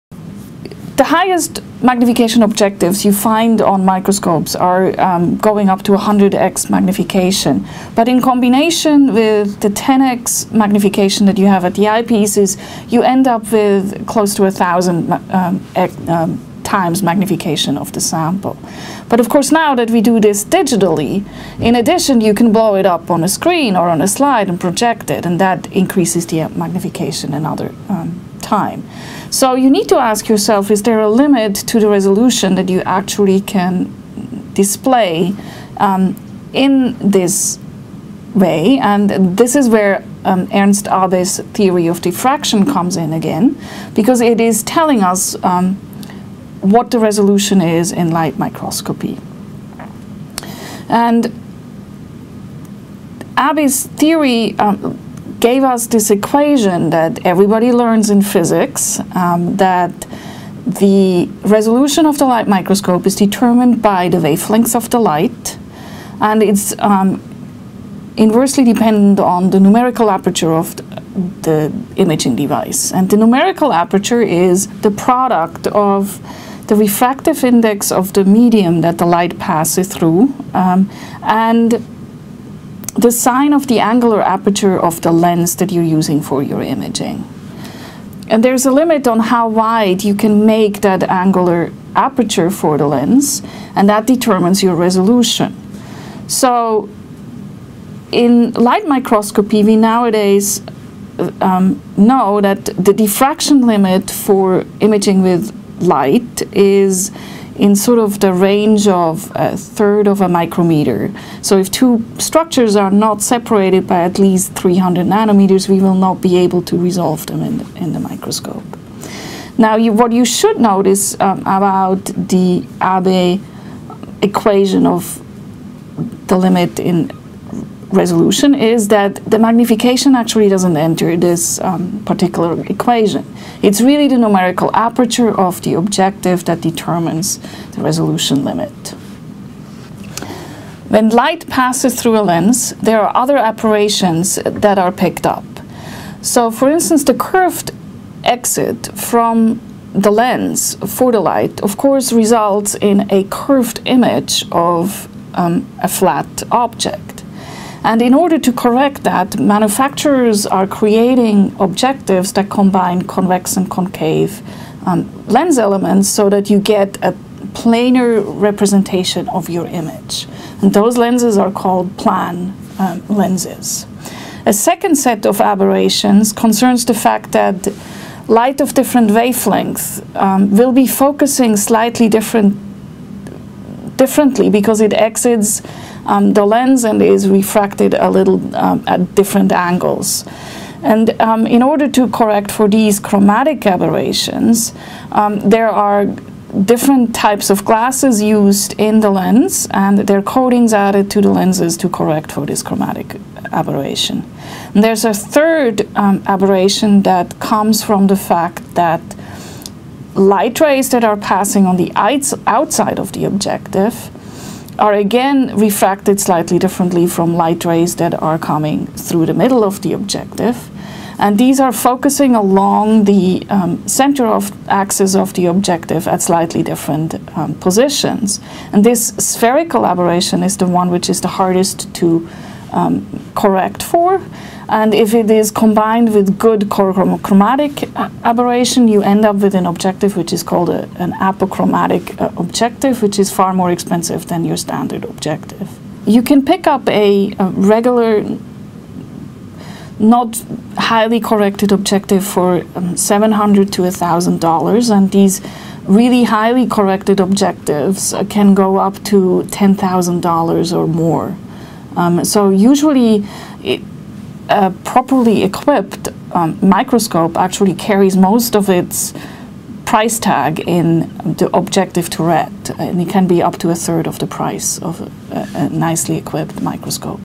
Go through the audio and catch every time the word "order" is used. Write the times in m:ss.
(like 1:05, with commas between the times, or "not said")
2:38, 3:11.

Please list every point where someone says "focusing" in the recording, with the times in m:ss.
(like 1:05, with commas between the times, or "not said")
3:00, 3:41.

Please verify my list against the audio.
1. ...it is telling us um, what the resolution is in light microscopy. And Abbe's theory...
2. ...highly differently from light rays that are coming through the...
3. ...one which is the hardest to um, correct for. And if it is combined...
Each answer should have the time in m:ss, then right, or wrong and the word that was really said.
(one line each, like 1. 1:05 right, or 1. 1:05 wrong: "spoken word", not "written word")
1. 0:44 right
2. 3:36 wrong: "slightly", not "highly"
3. 3:50 right.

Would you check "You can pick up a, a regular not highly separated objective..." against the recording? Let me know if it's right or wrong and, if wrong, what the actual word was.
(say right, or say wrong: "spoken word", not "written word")
wrong: "corrected", not "separated".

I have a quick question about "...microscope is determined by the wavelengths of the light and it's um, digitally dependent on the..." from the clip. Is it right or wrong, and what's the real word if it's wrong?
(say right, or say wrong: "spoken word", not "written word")
wrong: "inversely", not "digitally".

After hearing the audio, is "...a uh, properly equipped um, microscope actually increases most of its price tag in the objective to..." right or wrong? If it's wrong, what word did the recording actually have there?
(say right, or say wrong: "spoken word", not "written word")
wrong: "carries", not "increases".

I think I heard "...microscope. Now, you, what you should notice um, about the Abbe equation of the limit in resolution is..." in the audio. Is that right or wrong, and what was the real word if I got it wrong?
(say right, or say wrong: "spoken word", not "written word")
right.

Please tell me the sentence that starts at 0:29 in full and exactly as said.
So you need to ask yourself, is there a limit to the resolution that you actually can display um, in this way?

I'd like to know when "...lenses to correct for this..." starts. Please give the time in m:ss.
3:21.